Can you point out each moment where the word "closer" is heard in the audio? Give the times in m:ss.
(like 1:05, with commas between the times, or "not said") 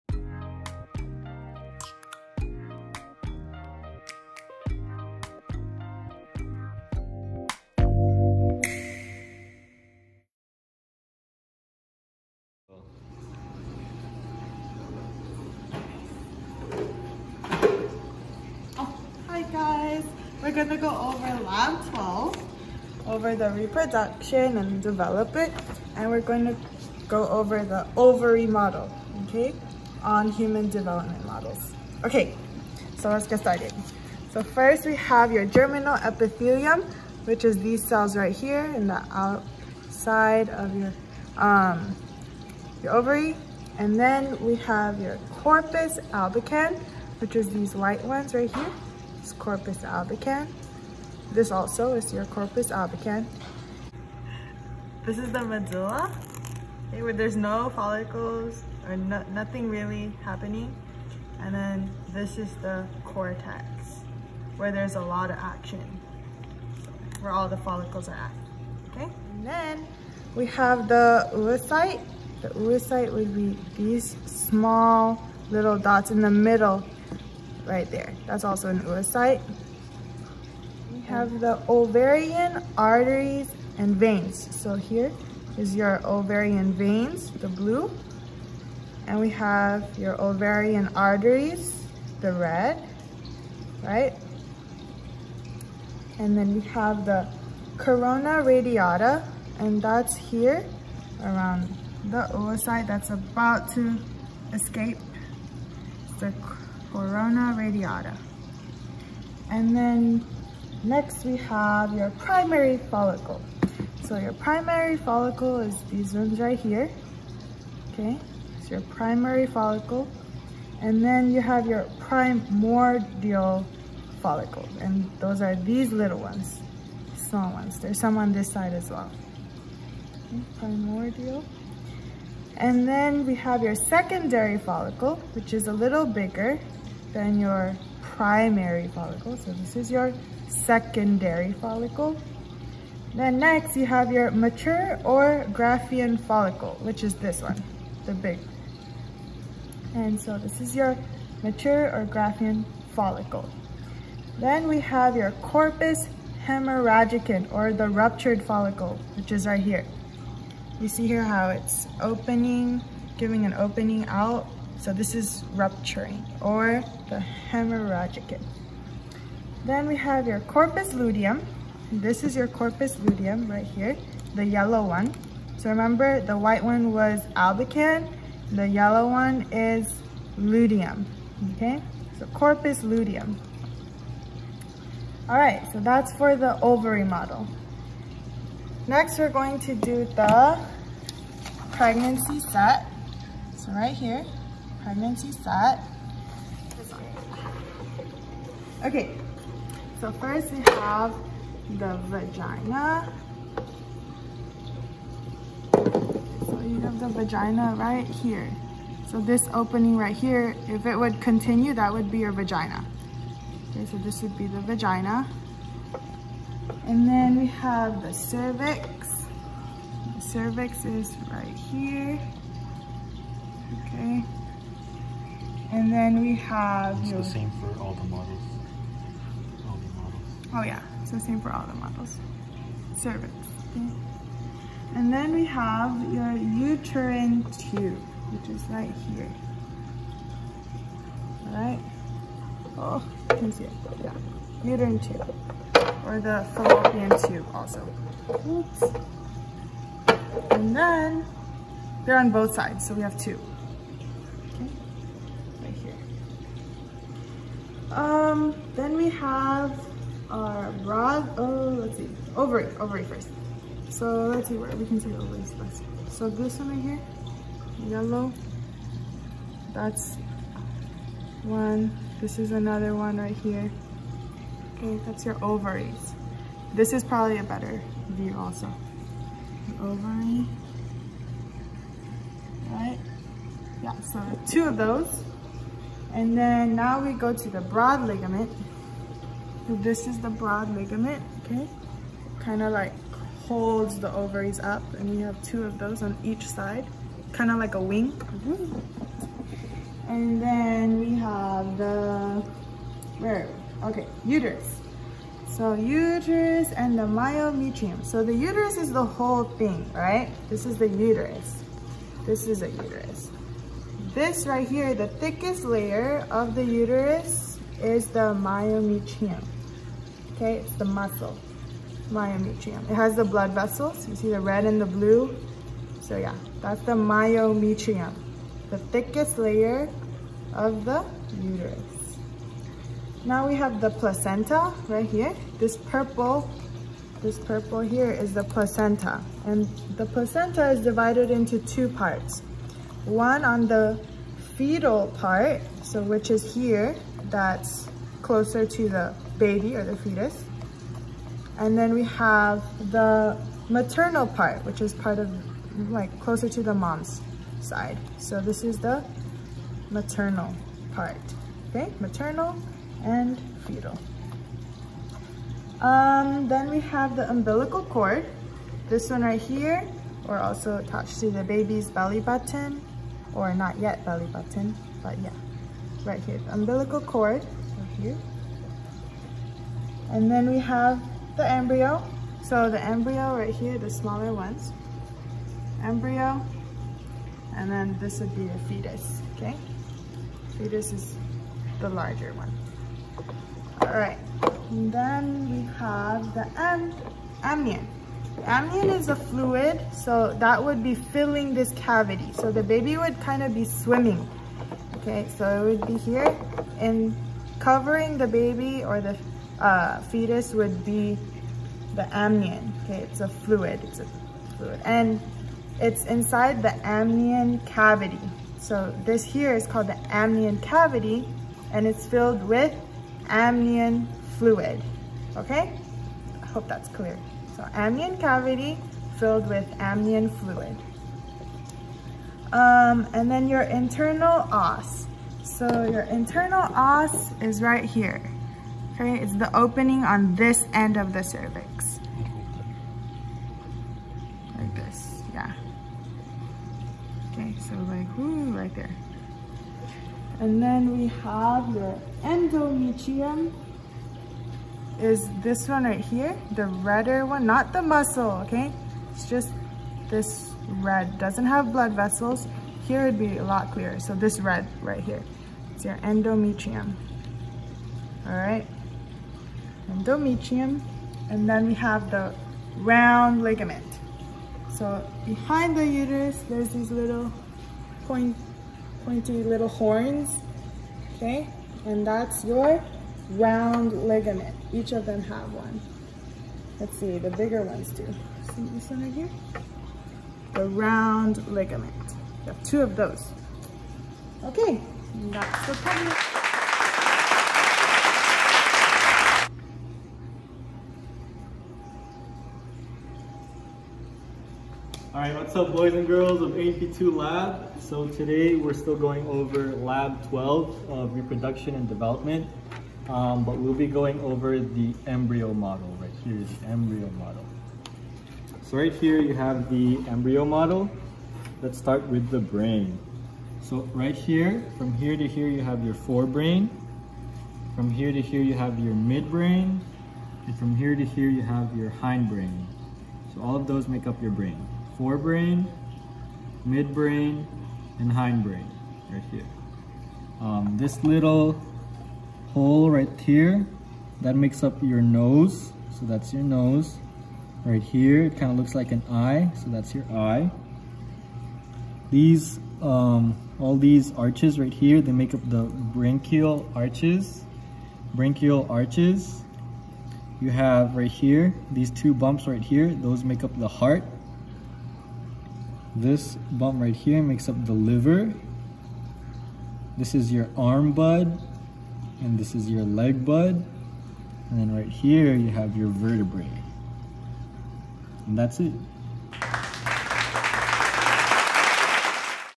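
5:48, 5:56.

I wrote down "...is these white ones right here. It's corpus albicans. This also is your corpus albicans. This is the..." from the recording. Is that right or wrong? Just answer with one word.
right.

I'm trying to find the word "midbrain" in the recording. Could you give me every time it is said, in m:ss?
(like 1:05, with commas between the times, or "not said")
8:48, 8:56.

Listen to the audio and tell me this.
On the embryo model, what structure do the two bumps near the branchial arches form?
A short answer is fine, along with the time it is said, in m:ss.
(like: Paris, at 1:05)
The heart, at 9:23.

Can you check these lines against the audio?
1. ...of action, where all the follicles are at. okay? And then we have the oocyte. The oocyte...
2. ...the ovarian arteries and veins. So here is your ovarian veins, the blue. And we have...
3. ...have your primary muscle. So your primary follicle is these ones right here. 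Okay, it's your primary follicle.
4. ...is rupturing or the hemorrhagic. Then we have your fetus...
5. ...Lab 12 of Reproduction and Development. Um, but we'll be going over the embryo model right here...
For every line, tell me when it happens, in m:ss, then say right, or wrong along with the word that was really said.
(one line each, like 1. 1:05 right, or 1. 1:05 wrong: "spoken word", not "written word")
1. 1:05 right
2. 1:21 right
3. 1:51 wrong: "follicle", not "muscle"
4. 2:45 wrong: "corpus", not "fetus"
5. 8:29 right.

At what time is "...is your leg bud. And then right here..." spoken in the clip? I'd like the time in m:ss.
9:32.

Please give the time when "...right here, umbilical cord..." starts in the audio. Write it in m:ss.
6:16.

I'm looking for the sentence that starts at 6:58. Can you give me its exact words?
So this here is called the amnion cavity and it's filled with amnion fluid.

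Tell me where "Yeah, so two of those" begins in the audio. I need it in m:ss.
4:43.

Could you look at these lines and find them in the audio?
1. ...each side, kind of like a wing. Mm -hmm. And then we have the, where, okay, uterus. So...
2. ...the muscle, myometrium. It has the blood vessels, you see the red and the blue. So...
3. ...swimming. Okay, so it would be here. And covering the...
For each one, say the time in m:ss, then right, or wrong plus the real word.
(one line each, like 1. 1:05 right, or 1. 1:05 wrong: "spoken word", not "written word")
1. 4:56 right
2. 5:20 right
3. 6:43 right.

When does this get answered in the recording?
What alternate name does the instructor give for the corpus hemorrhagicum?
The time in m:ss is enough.
2:37.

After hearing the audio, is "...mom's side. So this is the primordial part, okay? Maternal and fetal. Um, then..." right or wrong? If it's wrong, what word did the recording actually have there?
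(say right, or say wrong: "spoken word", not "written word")
wrong: "maternal", not "primordial".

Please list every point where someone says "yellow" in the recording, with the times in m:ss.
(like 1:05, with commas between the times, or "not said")
2:54, 2:58, 4:27.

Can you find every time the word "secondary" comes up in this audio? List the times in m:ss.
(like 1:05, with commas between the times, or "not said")
2:13, 2:20.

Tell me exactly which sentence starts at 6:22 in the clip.
So the embryo right here, the smaller ones, embryo, and then this would be a fetus, okay?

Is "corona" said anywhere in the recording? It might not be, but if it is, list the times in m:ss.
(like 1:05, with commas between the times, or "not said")
1:37, 1:46.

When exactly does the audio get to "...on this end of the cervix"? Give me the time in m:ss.
7:20.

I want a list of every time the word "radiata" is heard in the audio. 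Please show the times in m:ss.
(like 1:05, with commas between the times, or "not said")
1:38, 1:47.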